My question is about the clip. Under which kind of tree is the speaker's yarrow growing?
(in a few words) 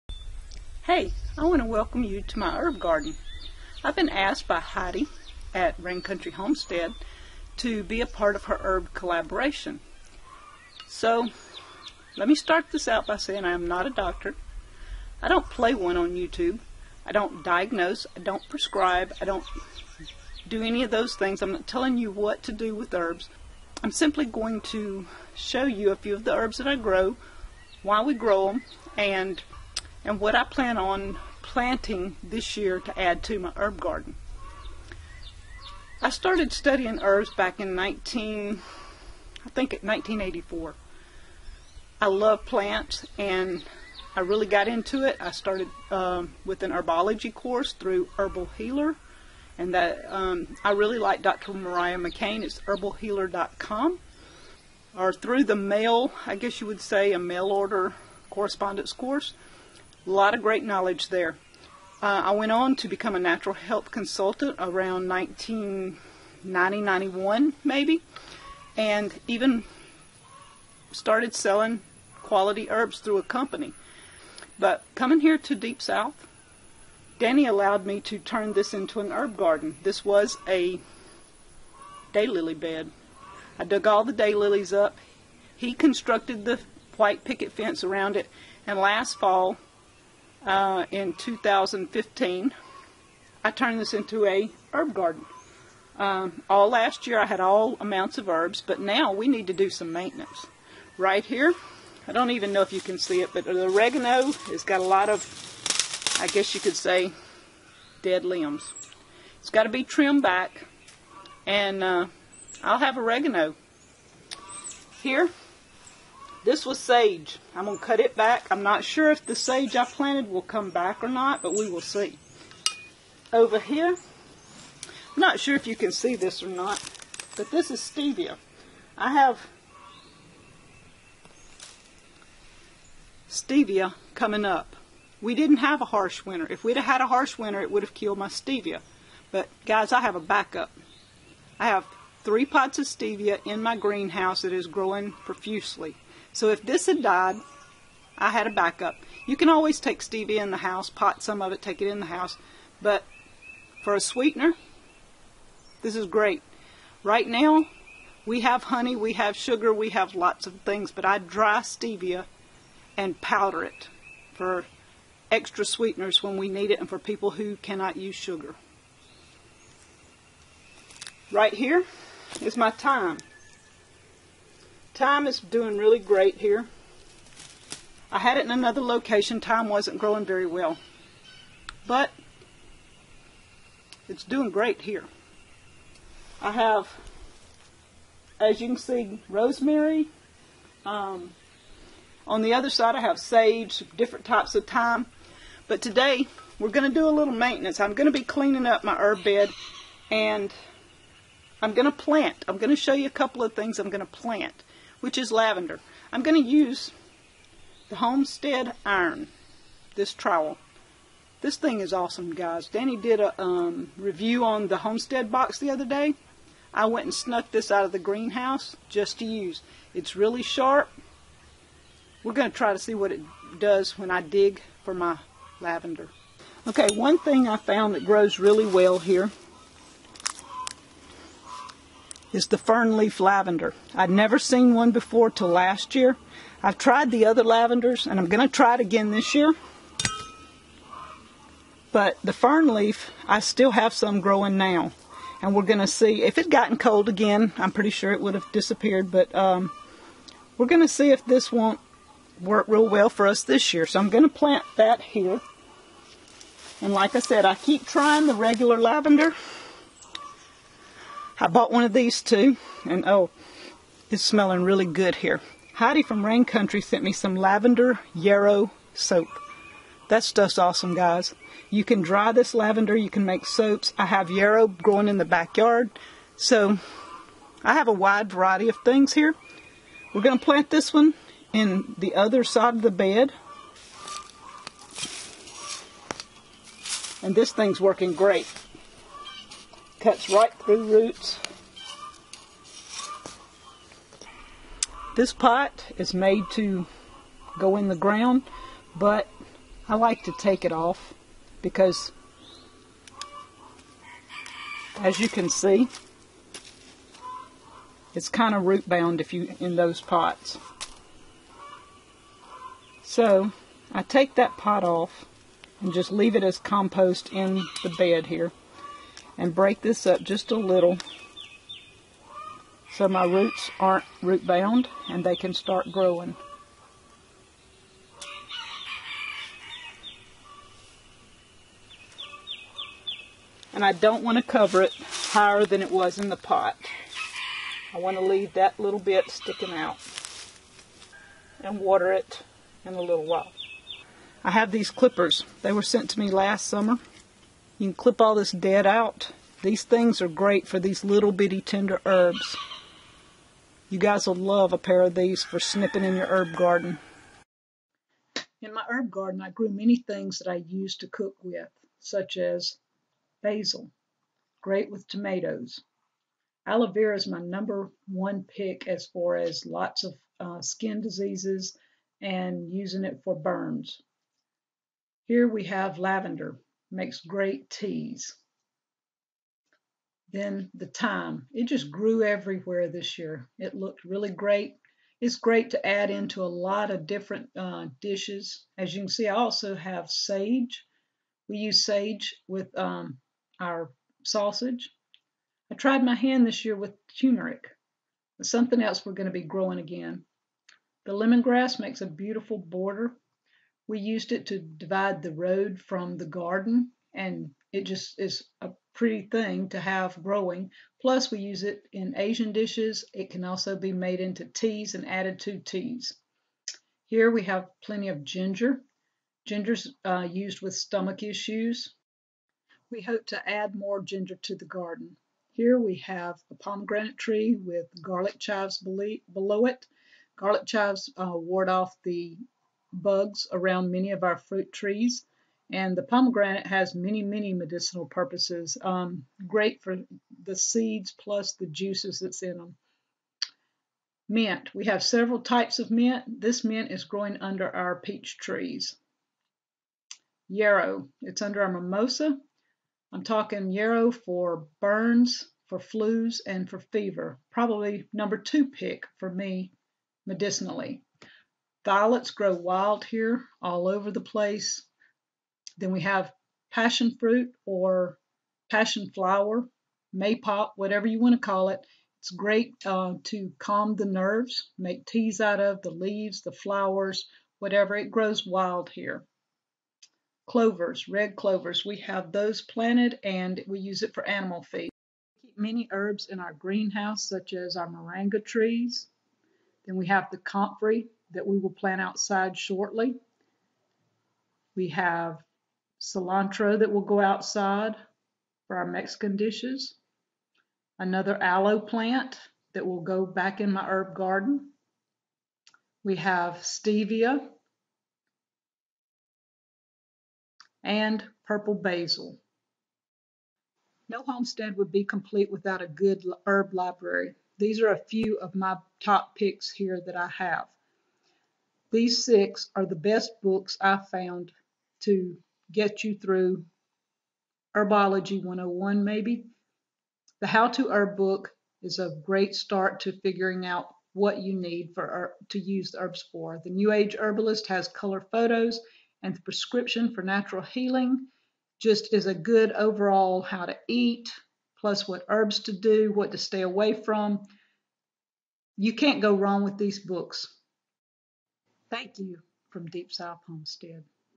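Mimosa.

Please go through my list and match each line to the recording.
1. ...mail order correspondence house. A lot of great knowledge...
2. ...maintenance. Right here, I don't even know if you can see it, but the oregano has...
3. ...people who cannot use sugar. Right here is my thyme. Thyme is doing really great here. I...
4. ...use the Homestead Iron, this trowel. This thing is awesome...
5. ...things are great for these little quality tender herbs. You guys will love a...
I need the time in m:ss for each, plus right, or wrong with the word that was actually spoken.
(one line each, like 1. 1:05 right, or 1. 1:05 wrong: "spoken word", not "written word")
1. 0:57 wrong: "course", not "house"
2. 1:39 right
3. 2:46 right
4. 3:26 right
5. 5:49 wrong: "bitty", not "quality".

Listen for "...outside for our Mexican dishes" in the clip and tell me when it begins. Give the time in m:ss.
8:17.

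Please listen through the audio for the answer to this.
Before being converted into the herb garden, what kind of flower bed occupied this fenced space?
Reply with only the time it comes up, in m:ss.
1:22.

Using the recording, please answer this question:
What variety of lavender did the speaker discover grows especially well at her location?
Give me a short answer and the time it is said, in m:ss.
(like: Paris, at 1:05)
Fern leaf lavender, at 3:52.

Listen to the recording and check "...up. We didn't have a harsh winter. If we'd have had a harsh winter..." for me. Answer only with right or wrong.
right.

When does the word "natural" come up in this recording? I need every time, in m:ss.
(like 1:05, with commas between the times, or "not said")
1:03, 9:00.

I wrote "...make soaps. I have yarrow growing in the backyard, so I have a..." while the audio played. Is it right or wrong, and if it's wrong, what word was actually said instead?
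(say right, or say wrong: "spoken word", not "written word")
right.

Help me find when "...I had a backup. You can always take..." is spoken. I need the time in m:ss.
2:28.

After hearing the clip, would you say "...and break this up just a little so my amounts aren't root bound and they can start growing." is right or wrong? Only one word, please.
wrong.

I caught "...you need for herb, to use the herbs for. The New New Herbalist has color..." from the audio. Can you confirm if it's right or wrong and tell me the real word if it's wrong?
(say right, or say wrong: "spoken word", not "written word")
wrong: "Age", not "New".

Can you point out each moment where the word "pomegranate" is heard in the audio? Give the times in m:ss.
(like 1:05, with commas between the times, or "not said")
7:06, 7:16.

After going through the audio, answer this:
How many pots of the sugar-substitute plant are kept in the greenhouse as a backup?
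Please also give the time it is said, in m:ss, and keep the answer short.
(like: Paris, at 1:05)
3, at 2:22.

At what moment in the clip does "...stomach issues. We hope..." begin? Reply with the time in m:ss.
7:00.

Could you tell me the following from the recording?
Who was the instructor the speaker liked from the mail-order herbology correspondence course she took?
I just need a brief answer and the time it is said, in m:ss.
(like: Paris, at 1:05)
Dr. Mariah McCain, at 0:51.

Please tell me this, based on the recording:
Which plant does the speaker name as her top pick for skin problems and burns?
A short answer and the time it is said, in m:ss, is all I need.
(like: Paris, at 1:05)
Aloe vera, at 6:06.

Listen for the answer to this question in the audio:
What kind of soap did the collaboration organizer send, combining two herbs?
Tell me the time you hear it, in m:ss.
4:27.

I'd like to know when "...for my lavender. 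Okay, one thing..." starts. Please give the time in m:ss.
3:44.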